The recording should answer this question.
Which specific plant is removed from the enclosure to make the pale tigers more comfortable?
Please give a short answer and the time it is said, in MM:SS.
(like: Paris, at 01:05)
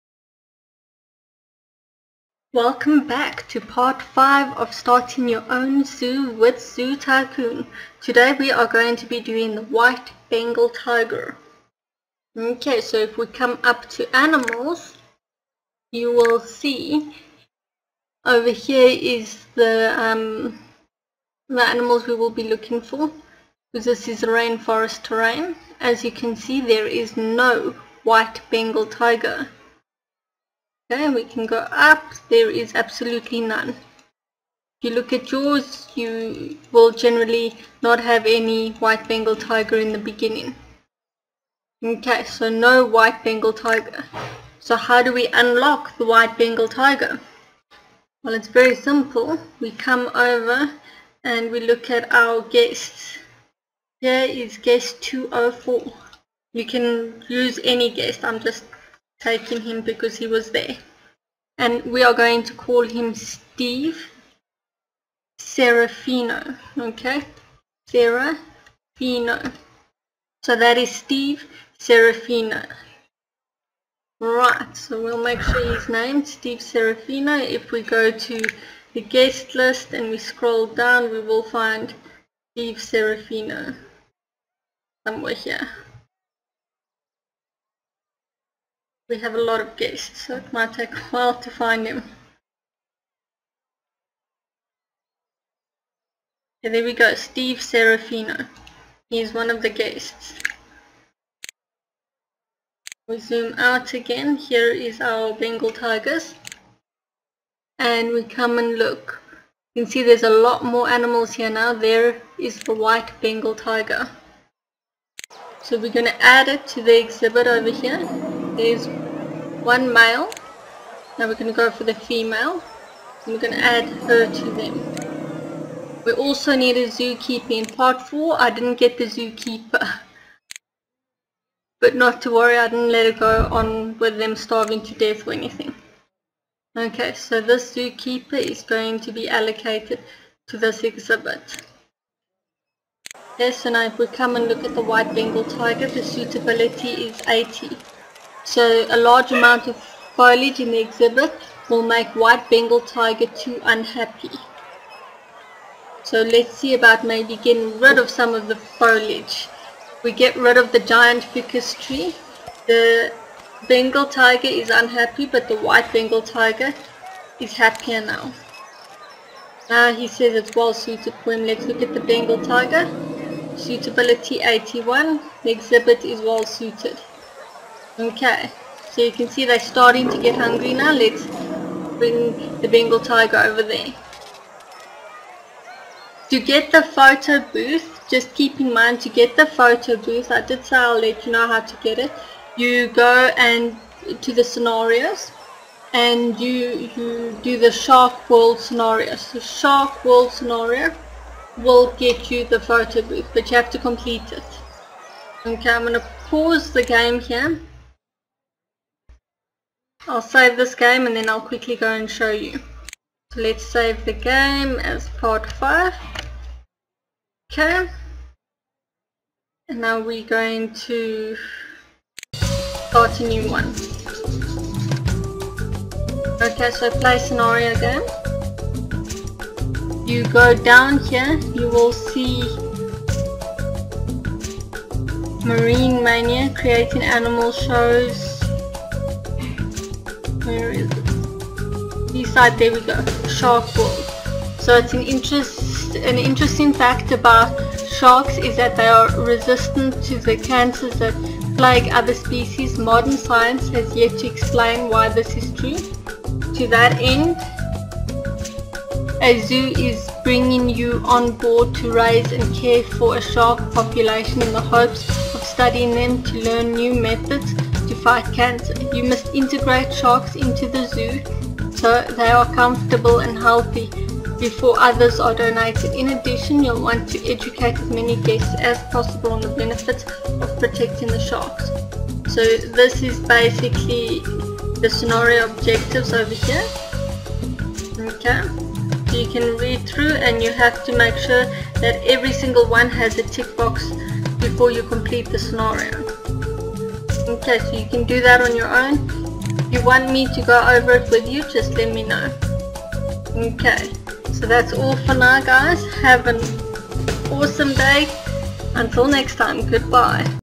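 giant ficus tree, at 02:40.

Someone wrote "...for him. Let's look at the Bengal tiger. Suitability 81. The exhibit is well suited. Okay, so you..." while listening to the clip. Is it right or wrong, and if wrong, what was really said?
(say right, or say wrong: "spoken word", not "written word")
right.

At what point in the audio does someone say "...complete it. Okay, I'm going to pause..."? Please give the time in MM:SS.
03:23.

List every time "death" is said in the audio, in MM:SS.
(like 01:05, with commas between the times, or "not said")
02:14.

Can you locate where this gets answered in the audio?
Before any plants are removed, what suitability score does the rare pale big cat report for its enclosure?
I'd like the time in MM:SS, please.
02:25.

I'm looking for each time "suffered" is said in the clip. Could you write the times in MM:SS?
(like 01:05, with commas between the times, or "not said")
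not said.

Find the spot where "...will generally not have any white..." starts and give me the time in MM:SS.
00:36.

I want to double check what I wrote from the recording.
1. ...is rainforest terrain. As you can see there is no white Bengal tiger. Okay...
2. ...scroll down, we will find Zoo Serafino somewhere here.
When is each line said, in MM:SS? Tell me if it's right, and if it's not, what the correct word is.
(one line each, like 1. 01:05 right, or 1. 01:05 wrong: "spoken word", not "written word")
1. 00:24 right
2. 01:20 wrong: "Steve", not "Zoo".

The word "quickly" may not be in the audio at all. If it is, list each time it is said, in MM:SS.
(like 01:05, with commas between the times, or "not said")
03:31.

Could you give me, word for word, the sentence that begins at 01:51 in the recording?
There is the white Bengal tiger.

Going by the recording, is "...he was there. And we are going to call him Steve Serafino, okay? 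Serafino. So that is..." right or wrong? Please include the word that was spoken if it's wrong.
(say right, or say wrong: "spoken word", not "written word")
right.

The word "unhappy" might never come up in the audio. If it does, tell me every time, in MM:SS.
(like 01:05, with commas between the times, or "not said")
02:33, 02:44.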